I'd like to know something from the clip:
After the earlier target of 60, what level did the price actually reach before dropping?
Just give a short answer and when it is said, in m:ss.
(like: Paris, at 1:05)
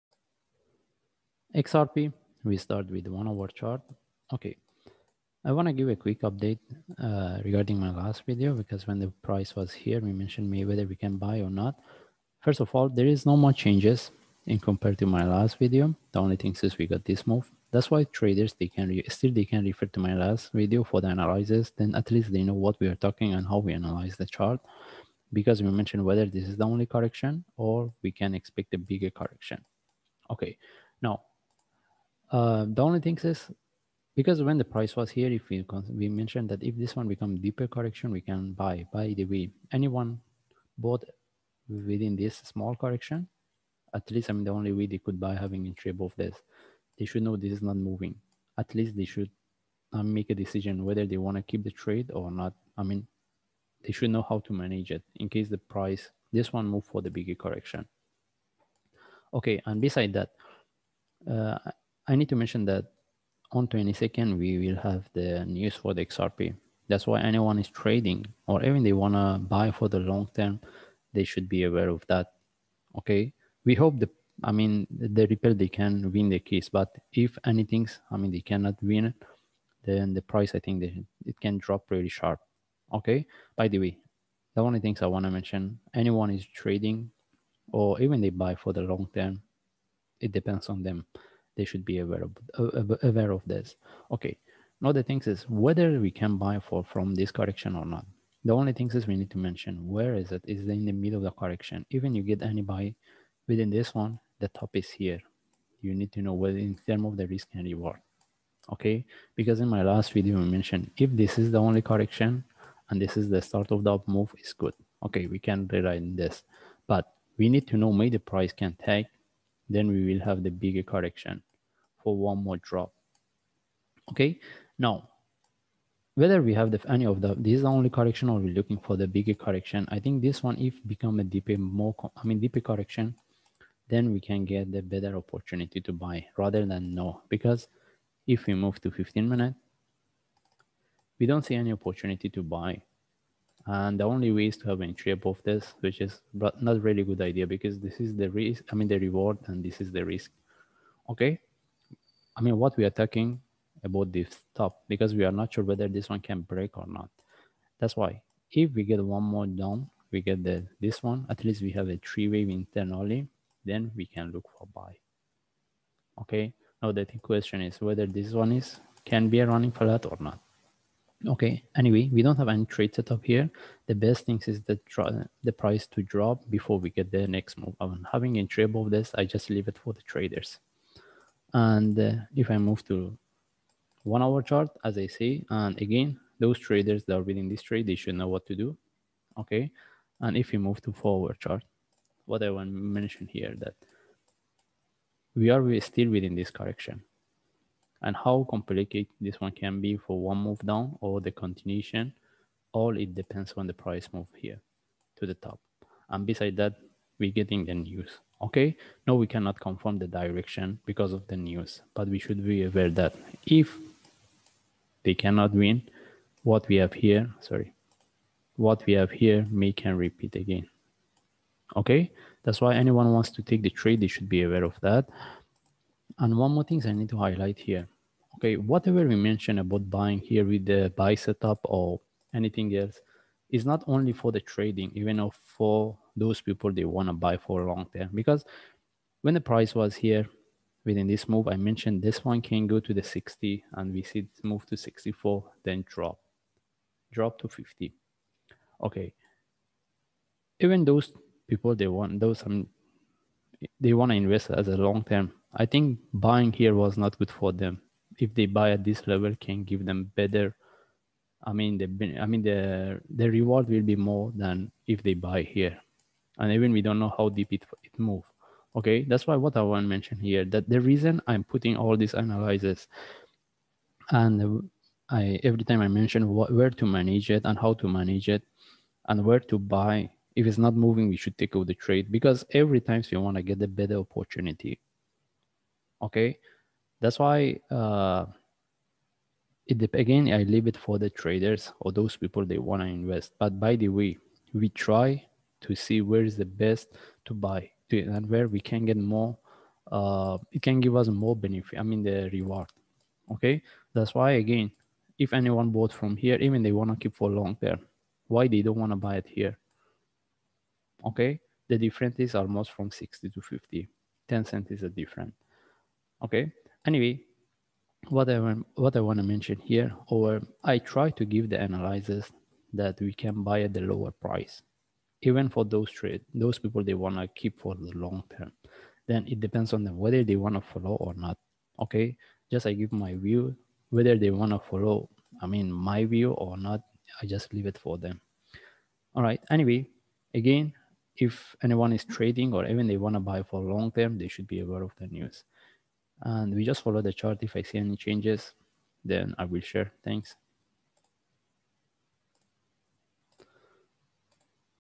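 64, at 4:04.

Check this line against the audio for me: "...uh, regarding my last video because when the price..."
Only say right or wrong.
right.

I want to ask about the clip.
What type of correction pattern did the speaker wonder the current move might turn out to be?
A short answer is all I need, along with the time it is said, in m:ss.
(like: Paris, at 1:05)
running flat, at 2:49.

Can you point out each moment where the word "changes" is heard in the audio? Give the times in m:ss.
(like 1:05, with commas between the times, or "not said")
0:13, 5:47.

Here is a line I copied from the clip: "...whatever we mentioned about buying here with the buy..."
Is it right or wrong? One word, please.
right.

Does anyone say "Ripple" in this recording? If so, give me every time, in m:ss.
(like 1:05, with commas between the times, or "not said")
1:15.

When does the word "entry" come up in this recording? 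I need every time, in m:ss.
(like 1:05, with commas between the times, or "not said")
0:45, 2:24.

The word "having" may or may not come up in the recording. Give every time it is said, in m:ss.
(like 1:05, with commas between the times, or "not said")
0:45, 2:58.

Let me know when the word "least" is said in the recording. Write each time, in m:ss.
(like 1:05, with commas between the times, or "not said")
0:22, 0:44, 0:48, 2:41.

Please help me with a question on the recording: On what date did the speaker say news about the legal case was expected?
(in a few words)
22nd.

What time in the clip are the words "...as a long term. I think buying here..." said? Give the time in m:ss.
4:14.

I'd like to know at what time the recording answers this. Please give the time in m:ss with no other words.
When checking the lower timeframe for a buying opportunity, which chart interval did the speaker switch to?
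2:18.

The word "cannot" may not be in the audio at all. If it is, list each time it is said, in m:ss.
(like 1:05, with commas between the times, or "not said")
1:18, 3:29, 3:35.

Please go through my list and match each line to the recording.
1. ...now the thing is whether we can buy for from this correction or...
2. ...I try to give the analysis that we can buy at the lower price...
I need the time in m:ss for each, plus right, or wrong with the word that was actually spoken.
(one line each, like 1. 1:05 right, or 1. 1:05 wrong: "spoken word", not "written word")
1. 1:34 right
2. 5:20 right.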